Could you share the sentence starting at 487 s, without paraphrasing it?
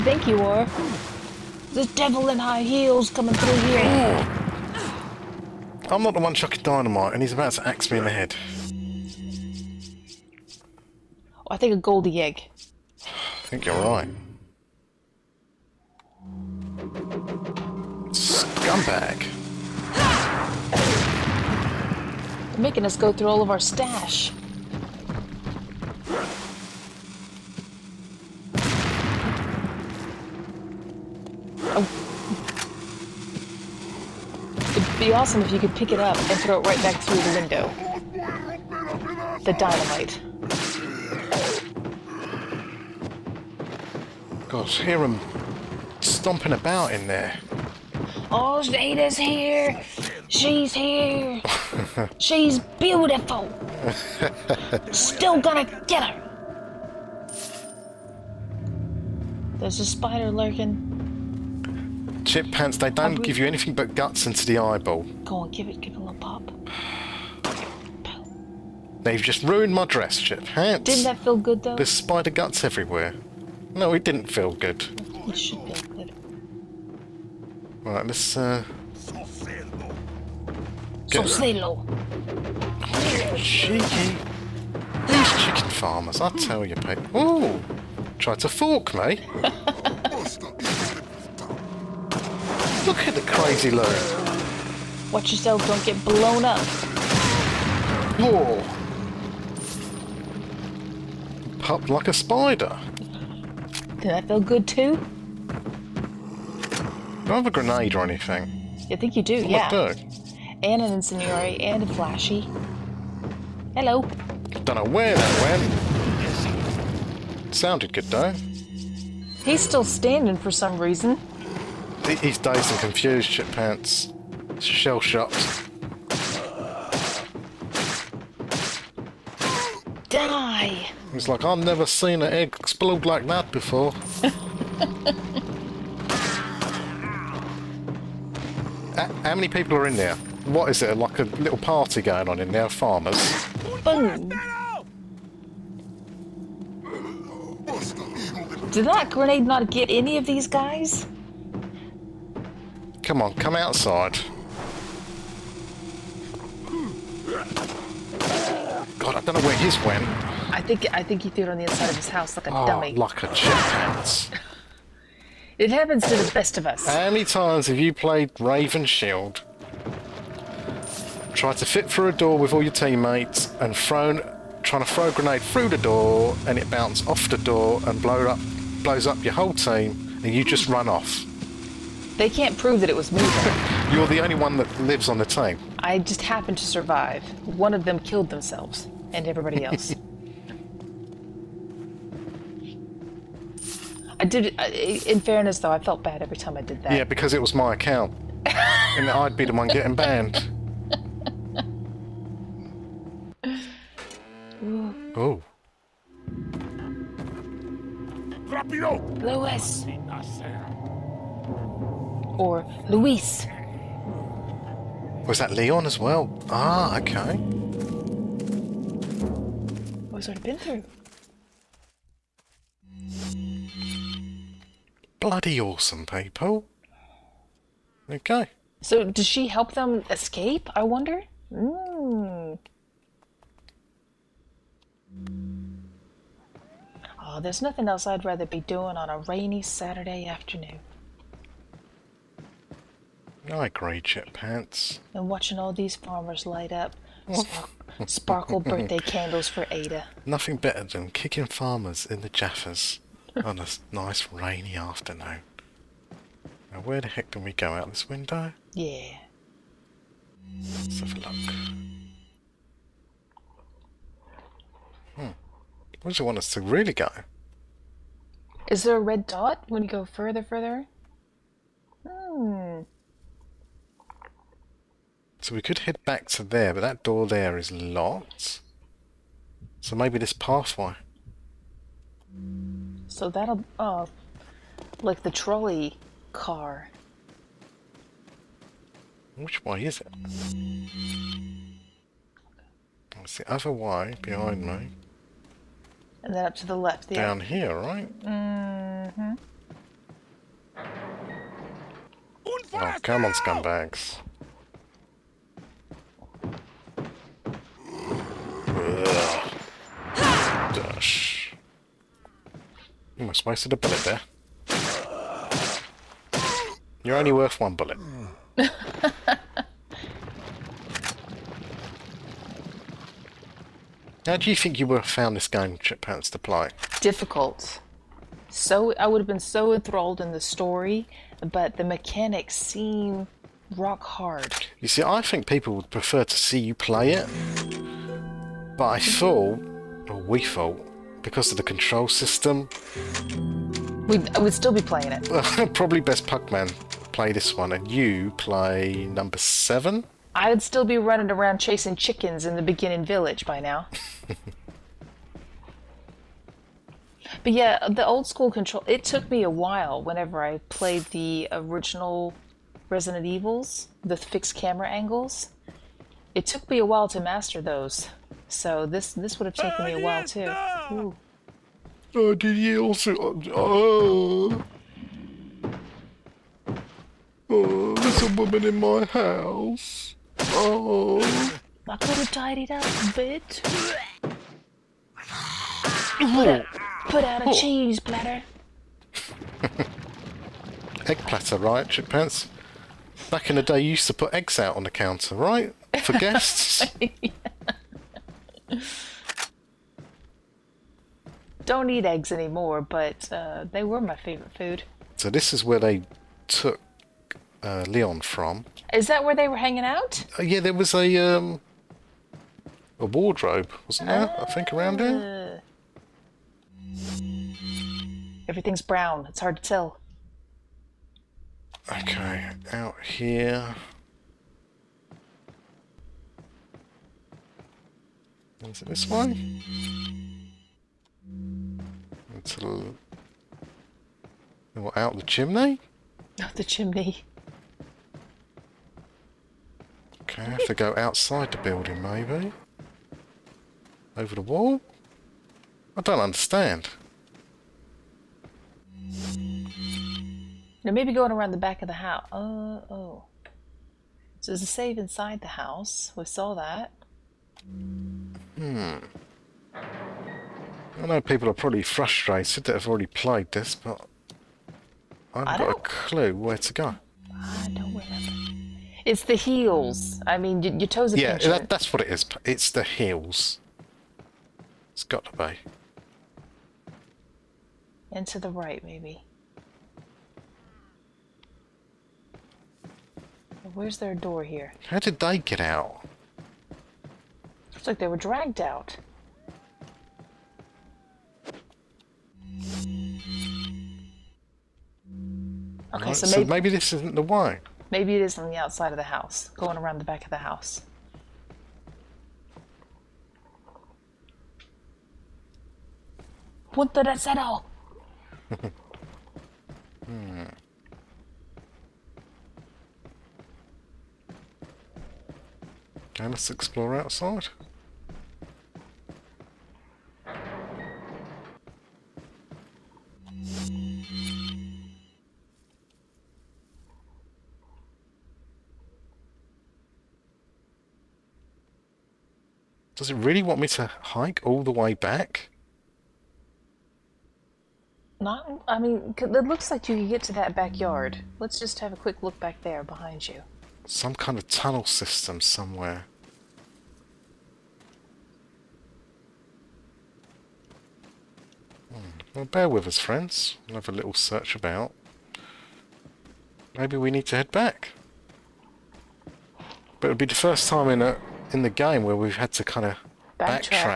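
Looks like they were dragged out.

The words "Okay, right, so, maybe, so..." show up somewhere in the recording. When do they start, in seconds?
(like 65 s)
495 s.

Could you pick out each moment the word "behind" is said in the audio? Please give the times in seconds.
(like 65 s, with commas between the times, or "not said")
294 s, 542 s.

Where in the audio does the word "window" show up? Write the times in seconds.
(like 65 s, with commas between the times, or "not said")
37 s, 258 s.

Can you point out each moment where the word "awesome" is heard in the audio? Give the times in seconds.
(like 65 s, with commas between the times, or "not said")
35 s, 225 s.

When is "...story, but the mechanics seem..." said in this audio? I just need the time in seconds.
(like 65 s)
330 s.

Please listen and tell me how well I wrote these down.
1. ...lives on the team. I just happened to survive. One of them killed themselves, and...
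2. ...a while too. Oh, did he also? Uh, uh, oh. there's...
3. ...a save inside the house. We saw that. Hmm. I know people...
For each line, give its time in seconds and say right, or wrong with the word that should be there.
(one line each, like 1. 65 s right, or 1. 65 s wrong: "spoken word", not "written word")
1. 184 s right
2. 369 s right
3. 454 s right.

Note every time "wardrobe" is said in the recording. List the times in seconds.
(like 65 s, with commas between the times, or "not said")
413 s.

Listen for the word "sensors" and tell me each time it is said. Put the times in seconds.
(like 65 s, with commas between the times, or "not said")
not said.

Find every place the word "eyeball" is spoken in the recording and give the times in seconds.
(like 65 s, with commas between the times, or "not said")
64 s.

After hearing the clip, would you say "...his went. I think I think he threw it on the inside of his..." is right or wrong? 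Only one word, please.
right.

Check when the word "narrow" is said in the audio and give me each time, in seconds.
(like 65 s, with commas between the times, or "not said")
not said.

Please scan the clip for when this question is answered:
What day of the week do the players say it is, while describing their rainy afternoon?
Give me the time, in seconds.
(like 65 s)
239 s.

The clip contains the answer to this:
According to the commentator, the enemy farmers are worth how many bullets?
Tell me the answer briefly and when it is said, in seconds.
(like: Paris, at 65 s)
1, at 317 s.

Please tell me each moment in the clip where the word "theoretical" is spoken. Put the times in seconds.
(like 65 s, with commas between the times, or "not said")
not said.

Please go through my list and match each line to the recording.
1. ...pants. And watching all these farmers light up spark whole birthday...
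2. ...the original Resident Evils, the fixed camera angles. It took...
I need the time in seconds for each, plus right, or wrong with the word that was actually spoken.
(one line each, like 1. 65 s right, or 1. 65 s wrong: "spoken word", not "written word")
1. 244 s wrong: "sparkle", not "whole"
2. 361 s right.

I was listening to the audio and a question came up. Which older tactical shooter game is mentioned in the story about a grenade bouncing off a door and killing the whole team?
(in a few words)
Raven Shield.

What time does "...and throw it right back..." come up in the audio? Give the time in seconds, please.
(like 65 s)
36 s.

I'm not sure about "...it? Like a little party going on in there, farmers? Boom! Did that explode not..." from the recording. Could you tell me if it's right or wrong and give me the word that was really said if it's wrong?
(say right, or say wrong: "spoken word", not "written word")
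wrong: "grenade", not "explode".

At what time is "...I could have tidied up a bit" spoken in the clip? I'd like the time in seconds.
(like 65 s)
381 s.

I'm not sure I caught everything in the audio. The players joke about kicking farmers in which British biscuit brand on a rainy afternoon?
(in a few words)
Jaffas.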